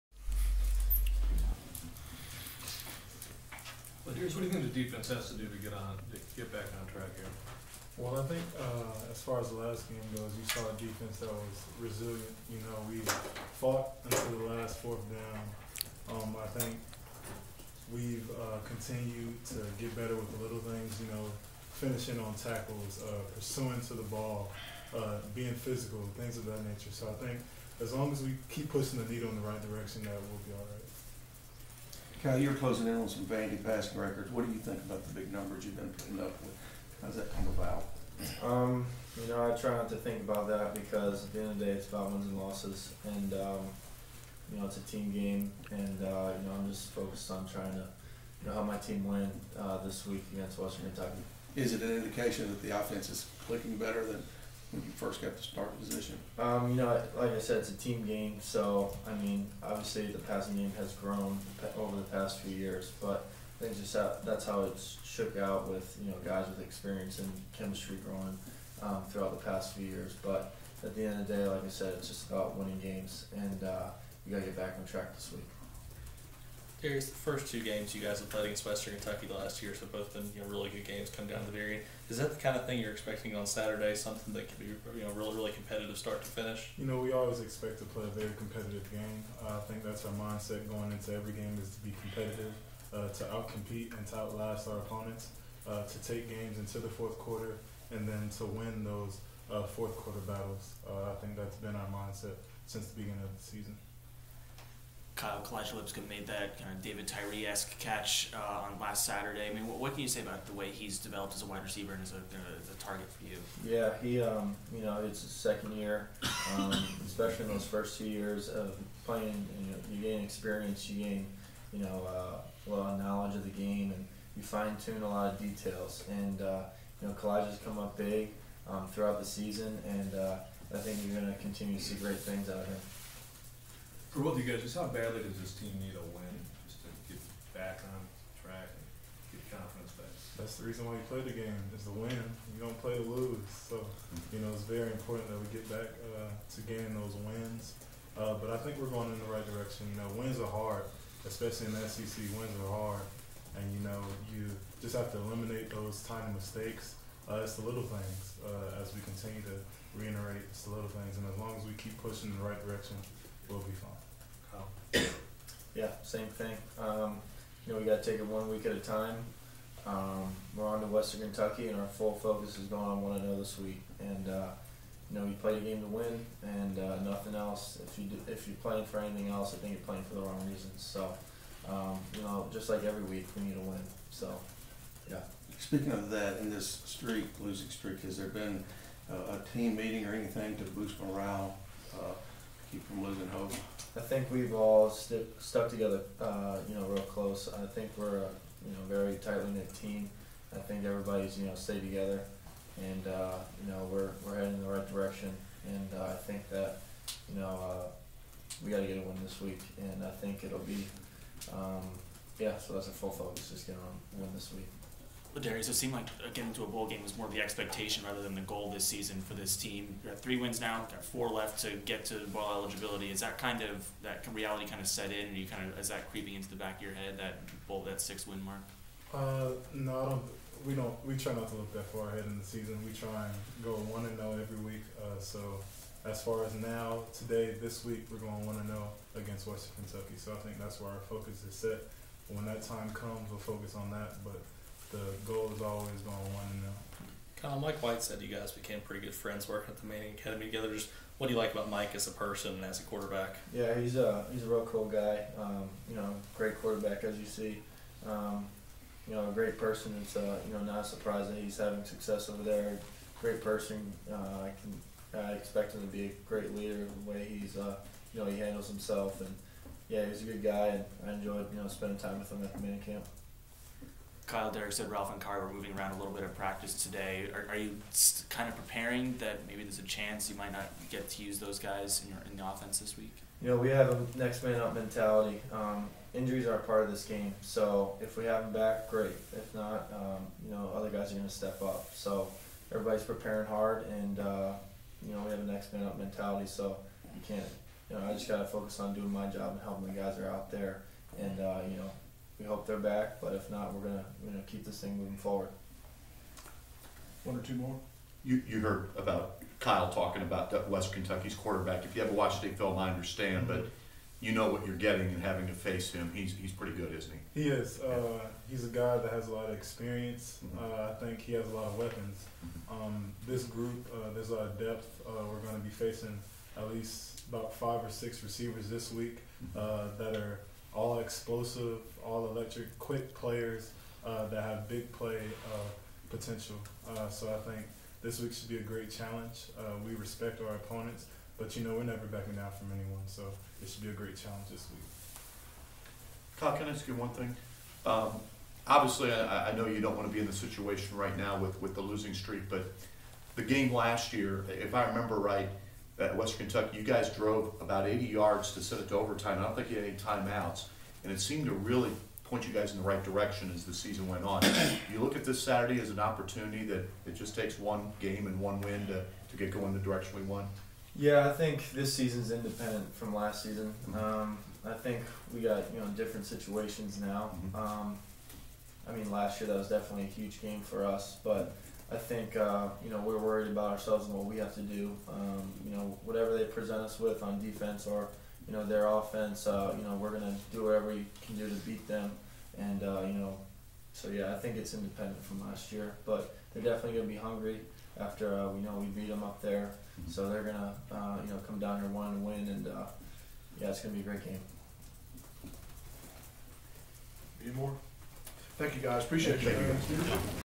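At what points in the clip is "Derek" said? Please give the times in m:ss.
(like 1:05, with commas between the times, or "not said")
4:34.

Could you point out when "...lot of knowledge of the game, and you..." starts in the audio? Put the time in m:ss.
2:02.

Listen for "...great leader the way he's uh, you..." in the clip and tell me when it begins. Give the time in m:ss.
4:26.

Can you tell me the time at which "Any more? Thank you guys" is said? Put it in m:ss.
6:47.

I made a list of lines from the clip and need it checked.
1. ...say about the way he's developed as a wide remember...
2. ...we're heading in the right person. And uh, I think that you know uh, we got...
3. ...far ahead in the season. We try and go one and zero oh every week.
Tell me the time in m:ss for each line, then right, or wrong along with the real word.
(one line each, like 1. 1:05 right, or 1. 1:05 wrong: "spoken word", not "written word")
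1. 1:50 wrong: "receiver", not "remember"
2. 3:24 wrong: "direction", not "person"
3. 3:51 right.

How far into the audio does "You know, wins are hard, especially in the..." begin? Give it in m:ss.
2:29.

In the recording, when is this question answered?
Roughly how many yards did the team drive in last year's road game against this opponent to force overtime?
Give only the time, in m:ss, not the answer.
5:57.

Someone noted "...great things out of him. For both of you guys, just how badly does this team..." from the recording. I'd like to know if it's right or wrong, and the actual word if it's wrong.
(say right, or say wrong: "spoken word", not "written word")
right.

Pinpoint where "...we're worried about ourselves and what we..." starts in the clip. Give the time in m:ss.
6:23.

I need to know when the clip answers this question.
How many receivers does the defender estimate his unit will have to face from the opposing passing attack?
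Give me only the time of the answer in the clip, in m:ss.
5:27.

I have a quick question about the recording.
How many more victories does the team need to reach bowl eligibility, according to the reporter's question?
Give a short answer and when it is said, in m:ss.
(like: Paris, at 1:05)
4, at 3:41.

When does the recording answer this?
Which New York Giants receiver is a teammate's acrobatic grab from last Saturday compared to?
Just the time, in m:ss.
1:46.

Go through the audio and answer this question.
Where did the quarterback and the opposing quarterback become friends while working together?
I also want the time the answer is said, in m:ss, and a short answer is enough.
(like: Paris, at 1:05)
Manning Academy, at 4:09.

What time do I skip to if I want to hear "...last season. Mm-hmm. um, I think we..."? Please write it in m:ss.
6:13.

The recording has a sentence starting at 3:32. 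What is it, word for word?
So that's a full focus, just getting a win this week.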